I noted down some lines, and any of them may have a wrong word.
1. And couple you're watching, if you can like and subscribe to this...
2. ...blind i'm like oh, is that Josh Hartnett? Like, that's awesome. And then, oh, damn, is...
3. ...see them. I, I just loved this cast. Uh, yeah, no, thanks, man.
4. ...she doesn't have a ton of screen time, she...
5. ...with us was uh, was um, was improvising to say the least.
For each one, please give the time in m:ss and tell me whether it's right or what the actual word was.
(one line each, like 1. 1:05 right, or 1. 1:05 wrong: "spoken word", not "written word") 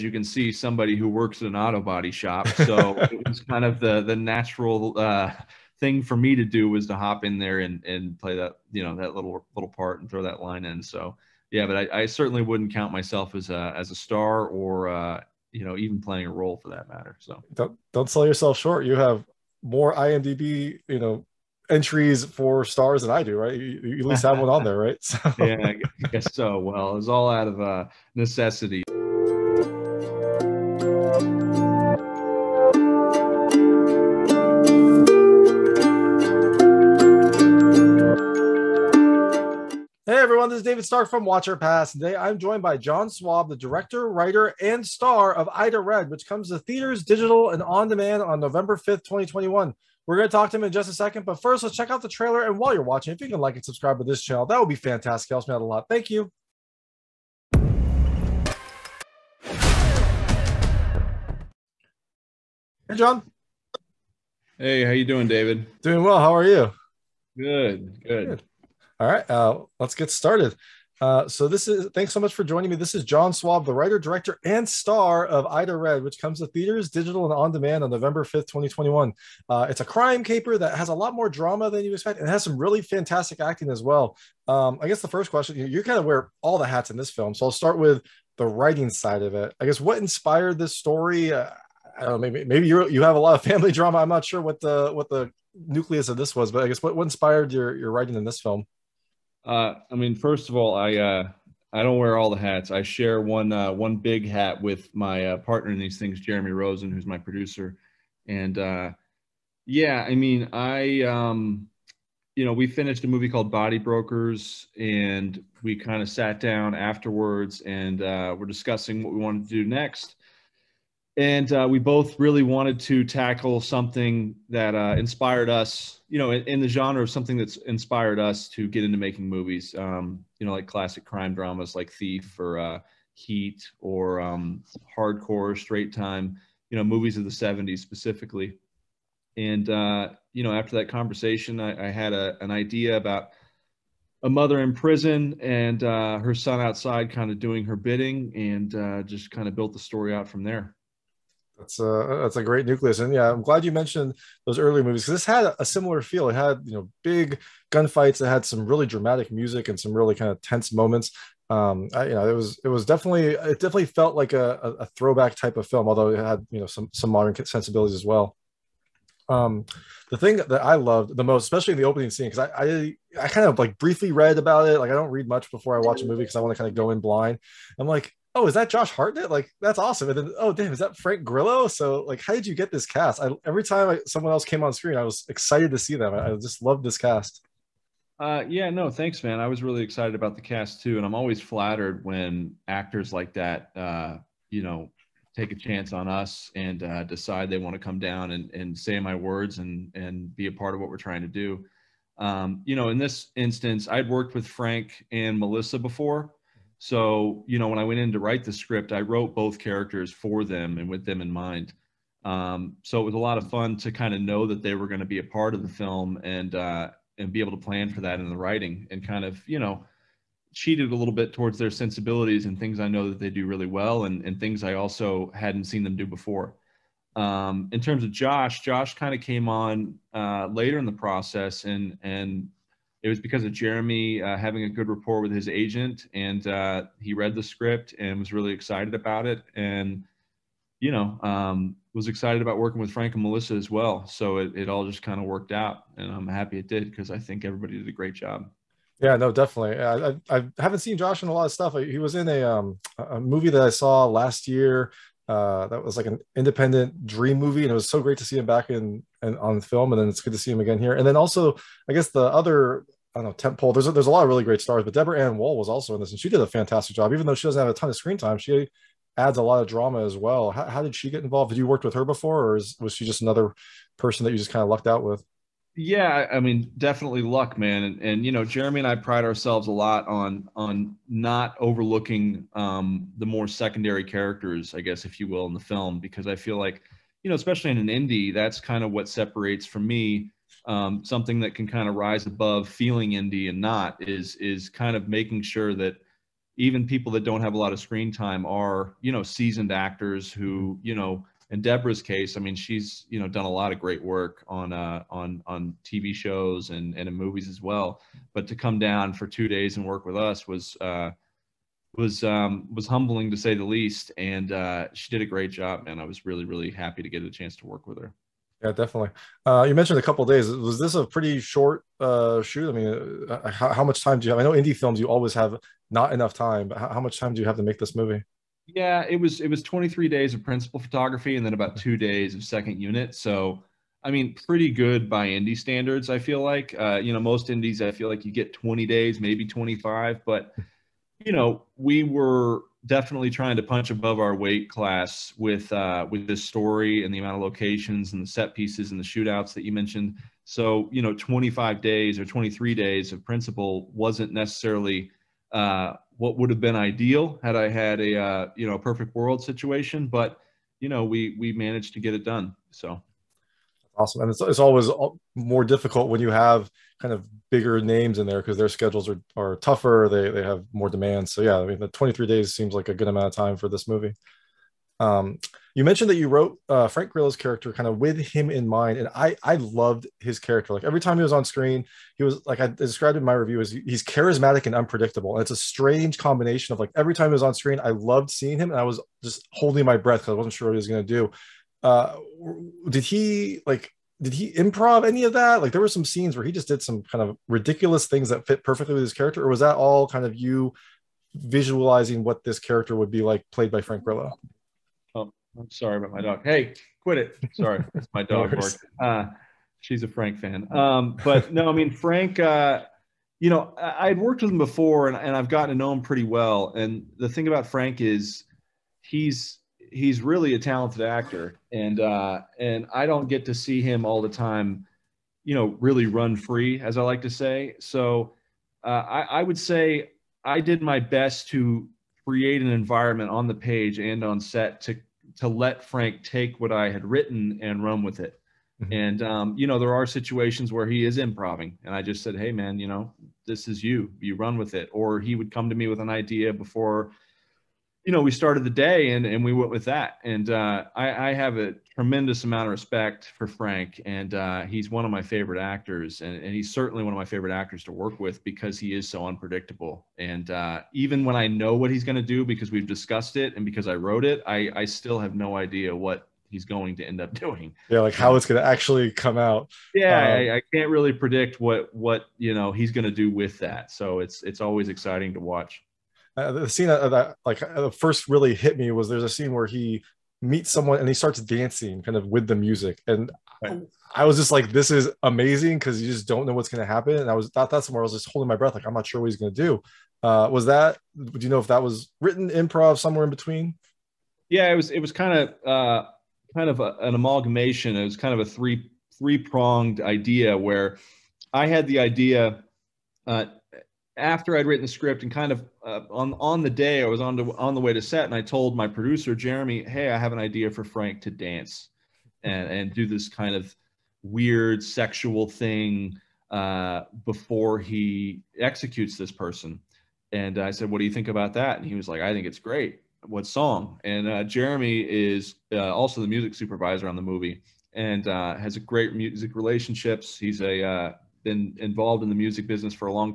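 1. 0:52 wrong: "while", not "couple"
2. 2:57 right
3. 3:05 right
4. 4:27 right
5. 5:10 wrong: "humbling", not "improvising".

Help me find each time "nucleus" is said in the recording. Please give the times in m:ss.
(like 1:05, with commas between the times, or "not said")
1:35, 2:32.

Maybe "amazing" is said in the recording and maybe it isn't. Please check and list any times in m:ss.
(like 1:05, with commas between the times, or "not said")
8:05.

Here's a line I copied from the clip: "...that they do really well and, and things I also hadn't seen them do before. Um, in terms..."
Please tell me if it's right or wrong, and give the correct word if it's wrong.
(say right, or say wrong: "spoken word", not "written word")
right.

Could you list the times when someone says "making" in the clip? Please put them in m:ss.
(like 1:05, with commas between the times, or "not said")
2:08, 4:55.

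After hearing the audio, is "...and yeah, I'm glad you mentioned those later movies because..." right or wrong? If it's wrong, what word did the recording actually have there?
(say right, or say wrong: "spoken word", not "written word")
wrong: "earlier", not "later".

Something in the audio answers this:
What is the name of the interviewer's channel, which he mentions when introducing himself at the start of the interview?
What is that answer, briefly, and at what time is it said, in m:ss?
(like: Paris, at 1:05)
Watch or Pass, at 0:41.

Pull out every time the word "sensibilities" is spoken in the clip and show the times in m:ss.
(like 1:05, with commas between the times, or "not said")
2:47, 3:41.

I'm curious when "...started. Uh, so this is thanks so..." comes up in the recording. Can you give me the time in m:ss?
1:10.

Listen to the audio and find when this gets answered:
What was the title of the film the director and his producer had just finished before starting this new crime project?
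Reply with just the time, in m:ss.
1:53.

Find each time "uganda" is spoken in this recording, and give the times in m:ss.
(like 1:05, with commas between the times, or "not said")
not said.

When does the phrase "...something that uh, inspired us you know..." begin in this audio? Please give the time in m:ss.
2:03.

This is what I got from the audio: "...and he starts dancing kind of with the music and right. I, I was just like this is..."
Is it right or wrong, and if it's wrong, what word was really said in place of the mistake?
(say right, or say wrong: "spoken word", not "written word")
right.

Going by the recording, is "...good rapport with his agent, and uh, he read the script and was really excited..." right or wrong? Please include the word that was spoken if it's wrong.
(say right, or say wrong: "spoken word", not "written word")
right.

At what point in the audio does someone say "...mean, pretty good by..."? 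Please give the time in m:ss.
5:34.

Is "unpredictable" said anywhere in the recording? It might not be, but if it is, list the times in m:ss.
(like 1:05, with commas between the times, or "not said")
6:24, 7:39.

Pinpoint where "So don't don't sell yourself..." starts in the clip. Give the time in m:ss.
0:17.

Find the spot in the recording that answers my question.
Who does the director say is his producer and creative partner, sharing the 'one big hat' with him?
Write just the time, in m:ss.
1:46.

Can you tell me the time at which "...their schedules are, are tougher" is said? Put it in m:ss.
6:08.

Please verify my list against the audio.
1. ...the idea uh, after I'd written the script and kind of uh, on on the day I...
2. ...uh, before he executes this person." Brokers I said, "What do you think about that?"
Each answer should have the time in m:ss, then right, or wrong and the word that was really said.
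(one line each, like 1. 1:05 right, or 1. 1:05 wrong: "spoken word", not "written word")
1. 8:21 right
2. 8:36 wrong: "And", not "Brokers".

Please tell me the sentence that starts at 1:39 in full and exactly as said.
Uh, I mean, first of all, I uh, I don't wear all the hats.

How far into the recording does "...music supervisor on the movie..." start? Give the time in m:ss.
8:46.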